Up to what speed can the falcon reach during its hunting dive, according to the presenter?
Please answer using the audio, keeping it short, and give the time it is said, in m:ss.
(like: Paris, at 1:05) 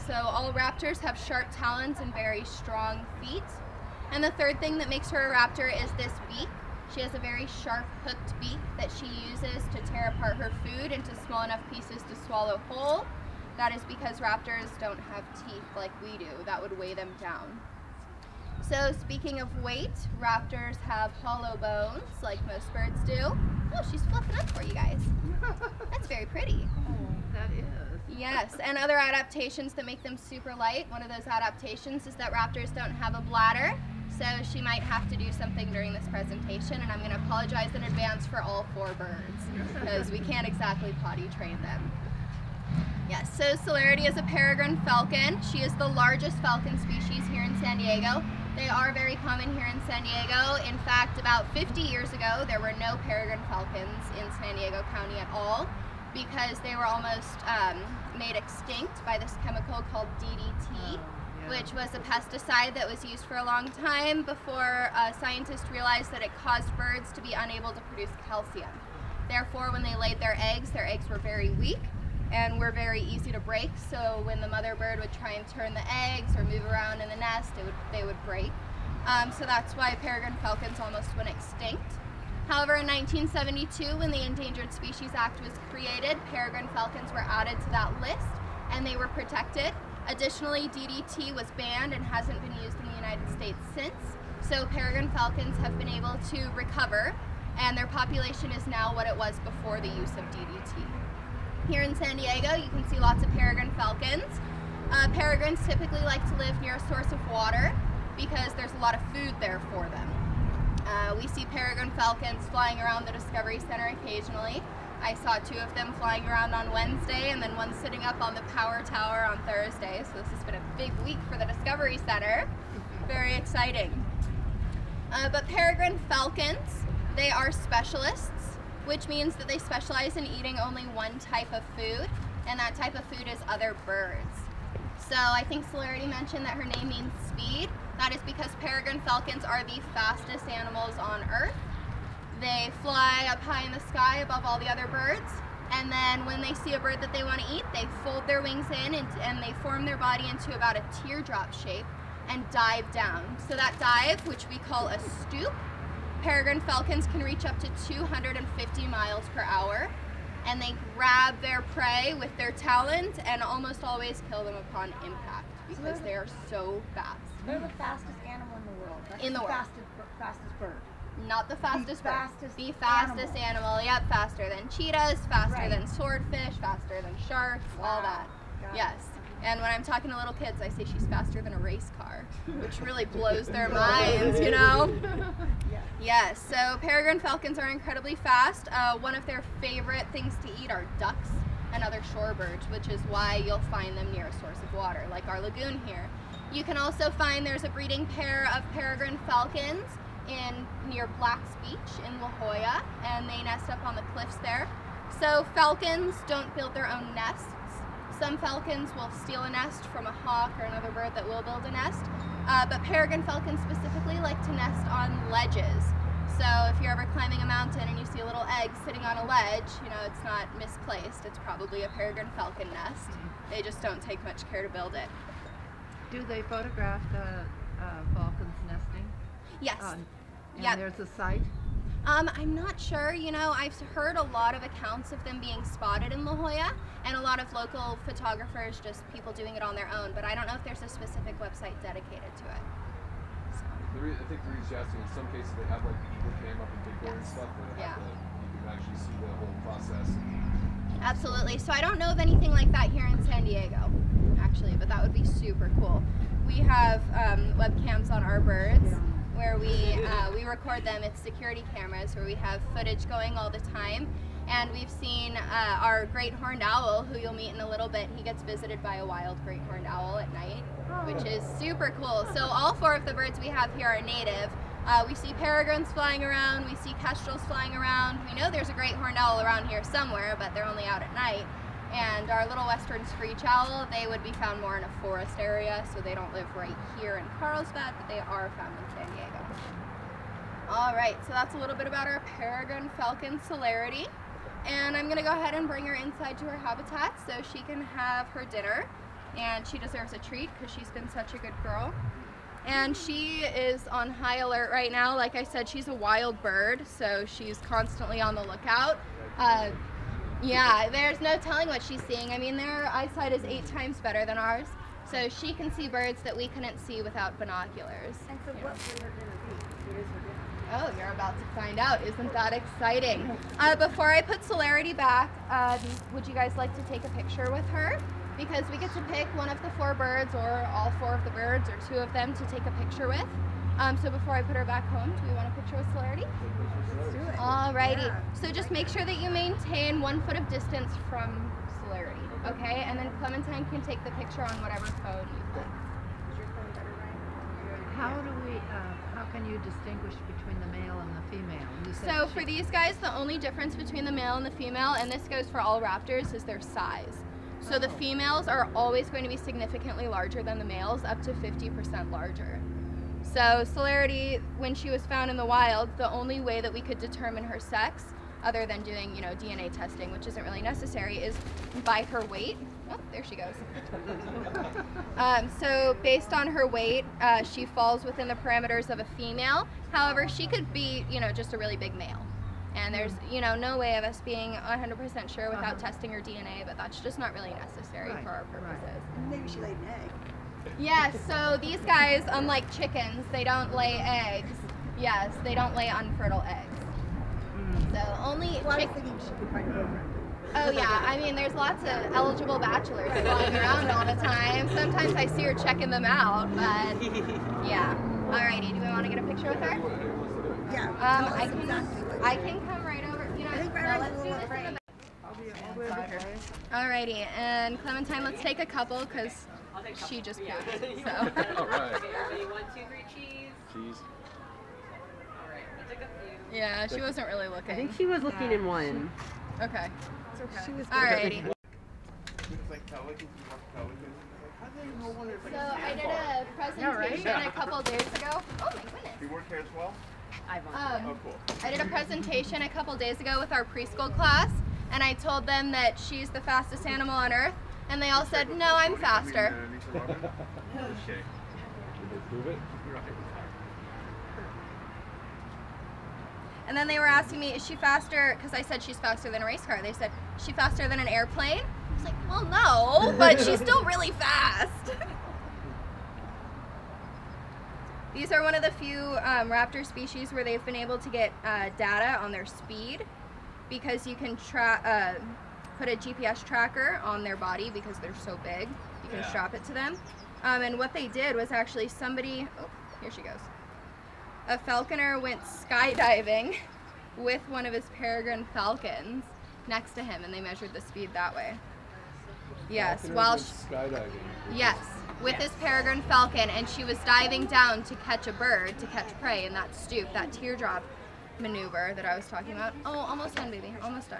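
250 miles per hour, at 2:37.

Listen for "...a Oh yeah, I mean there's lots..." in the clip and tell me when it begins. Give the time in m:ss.
6:39.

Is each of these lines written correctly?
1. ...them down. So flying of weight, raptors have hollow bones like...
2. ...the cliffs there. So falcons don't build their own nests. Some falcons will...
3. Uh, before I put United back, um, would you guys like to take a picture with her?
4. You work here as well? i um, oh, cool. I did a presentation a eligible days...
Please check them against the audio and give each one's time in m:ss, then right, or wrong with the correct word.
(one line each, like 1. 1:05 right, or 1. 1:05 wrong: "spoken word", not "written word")
1. 0:16 wrong: "speaking", not "flying"
2. 3:23 right
3. 5:23 wrong: "Celerity", not "United"
4. 7:19 wrong: "couple", not "eligible".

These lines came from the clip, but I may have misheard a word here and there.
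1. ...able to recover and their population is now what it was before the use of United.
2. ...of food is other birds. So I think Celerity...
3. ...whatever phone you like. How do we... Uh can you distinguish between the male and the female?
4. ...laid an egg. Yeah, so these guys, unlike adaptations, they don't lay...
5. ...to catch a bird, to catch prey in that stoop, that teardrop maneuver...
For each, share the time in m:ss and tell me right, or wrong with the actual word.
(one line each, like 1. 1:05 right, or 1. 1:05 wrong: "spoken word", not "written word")
1. 1:35 wrong: "DDT", not "United"
2. 2:12 right
3. 5:44 right
4. 6:29 wrong: "chickens", not "adaptations"
5. 8:17 right.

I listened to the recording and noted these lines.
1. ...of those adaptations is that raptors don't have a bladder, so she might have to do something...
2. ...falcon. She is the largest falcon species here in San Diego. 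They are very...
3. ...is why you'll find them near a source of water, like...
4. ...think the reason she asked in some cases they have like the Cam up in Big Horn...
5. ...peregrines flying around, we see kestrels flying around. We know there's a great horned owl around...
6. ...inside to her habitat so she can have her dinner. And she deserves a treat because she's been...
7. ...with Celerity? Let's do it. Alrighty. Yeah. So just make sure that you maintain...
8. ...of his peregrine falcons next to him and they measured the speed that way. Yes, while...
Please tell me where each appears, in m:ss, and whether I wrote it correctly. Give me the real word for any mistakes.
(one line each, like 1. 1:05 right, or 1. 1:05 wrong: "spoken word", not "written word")
1. 0:31 right
2. 0:44 right
3. 3:12 right
4. 4:04 right
5. 4:35 right
6. 4:55 right
7. 5:35 right
8. 8:07 right.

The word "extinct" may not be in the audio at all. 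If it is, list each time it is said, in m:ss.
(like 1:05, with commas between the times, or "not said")
0:58, 1:21.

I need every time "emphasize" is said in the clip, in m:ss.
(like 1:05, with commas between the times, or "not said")
not said.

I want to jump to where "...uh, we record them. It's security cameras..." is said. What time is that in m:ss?
4:20.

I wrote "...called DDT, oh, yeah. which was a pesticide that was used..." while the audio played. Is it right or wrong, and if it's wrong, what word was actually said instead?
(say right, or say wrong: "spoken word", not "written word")
right.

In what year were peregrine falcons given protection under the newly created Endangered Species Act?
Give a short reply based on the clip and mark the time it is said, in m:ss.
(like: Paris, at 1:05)
1972, at 1:22.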